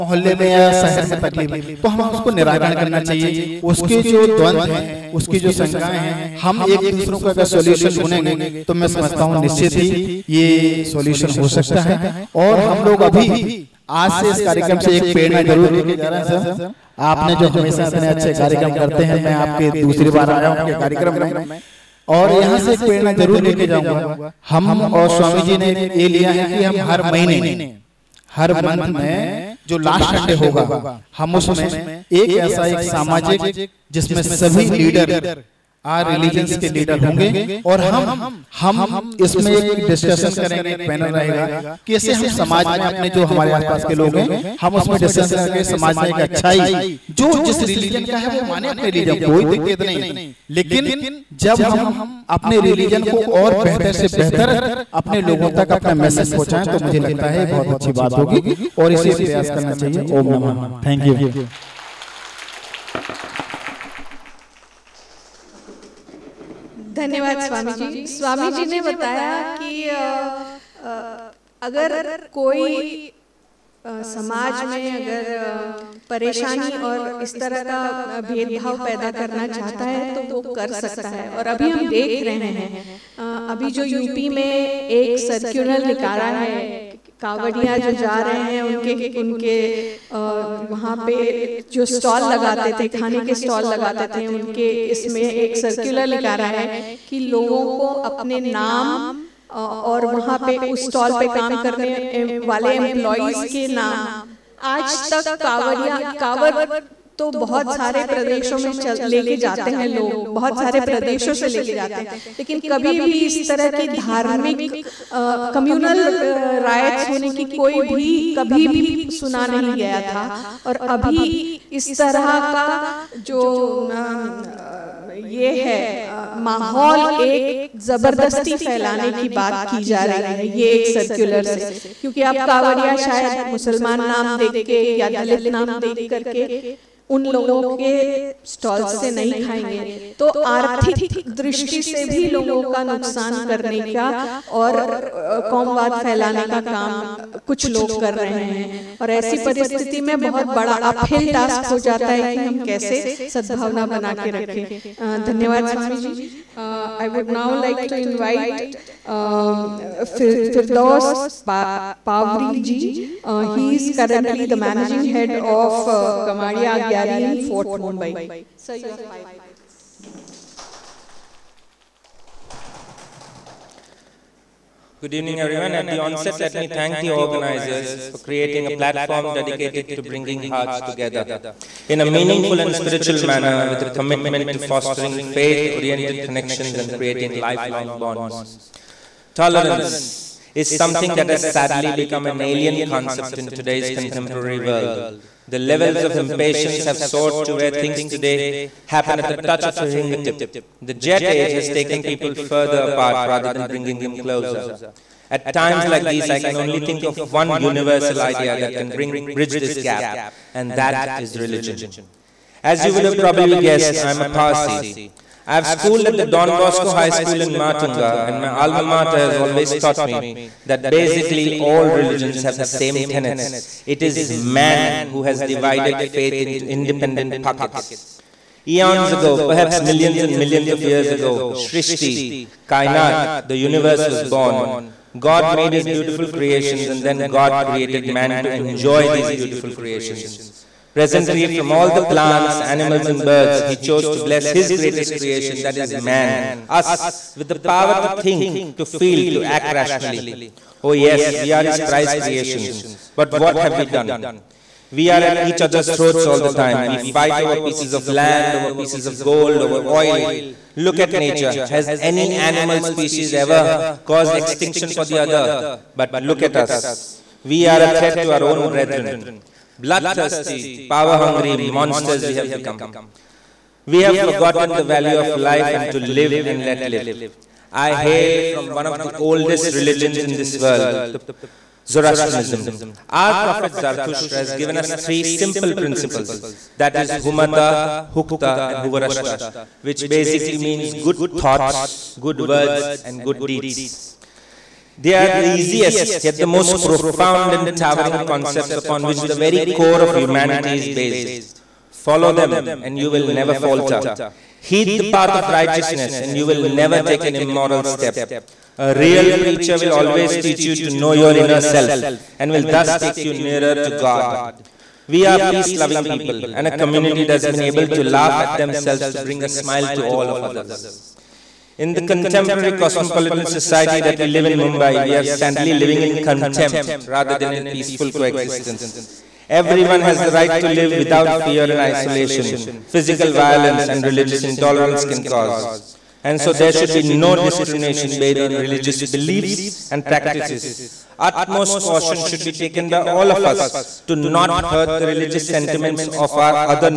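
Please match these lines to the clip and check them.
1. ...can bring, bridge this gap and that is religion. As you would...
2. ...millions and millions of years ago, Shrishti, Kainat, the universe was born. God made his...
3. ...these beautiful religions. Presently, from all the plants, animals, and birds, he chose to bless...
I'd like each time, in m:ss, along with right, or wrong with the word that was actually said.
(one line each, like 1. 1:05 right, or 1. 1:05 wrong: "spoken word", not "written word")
1. 3:28 right
2. 3:49 right
3. 3:59 wrong: "creations", not "religions".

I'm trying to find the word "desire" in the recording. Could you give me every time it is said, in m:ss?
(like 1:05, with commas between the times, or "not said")
not said.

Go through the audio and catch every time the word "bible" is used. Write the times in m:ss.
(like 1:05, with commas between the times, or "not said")
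not said.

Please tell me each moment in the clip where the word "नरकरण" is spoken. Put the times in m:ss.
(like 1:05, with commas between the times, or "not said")
0:02.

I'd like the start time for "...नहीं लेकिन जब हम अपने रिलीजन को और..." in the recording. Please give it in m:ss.
0:49.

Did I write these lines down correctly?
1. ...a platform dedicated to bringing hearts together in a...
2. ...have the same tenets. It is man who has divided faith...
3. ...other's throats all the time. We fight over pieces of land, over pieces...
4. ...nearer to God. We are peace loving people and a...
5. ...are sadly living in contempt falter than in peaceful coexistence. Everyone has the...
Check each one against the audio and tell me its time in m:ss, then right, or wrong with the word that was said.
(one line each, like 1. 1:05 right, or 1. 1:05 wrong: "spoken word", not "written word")
1. 2:58 right
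2. 3:42 right
3. 4:15 right
4. 5:13 right
5. 5:25 wrong: "rather", not "falter".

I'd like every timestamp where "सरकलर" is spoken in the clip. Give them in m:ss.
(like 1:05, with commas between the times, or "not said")
1:35, 2:10.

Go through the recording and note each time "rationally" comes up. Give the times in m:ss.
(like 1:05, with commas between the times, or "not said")
4:09.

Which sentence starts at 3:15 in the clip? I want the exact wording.
The levels of impatience have soared to where things today happen at the touch of a fingertip.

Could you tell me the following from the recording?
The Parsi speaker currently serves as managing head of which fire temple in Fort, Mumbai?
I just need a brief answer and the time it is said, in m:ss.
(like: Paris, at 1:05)
Gamadia Agyari, at 2:46.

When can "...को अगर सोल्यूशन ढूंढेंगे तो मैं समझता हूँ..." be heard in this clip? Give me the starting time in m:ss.
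0:07.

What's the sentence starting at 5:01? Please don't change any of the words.
Follow them, and you will never falter.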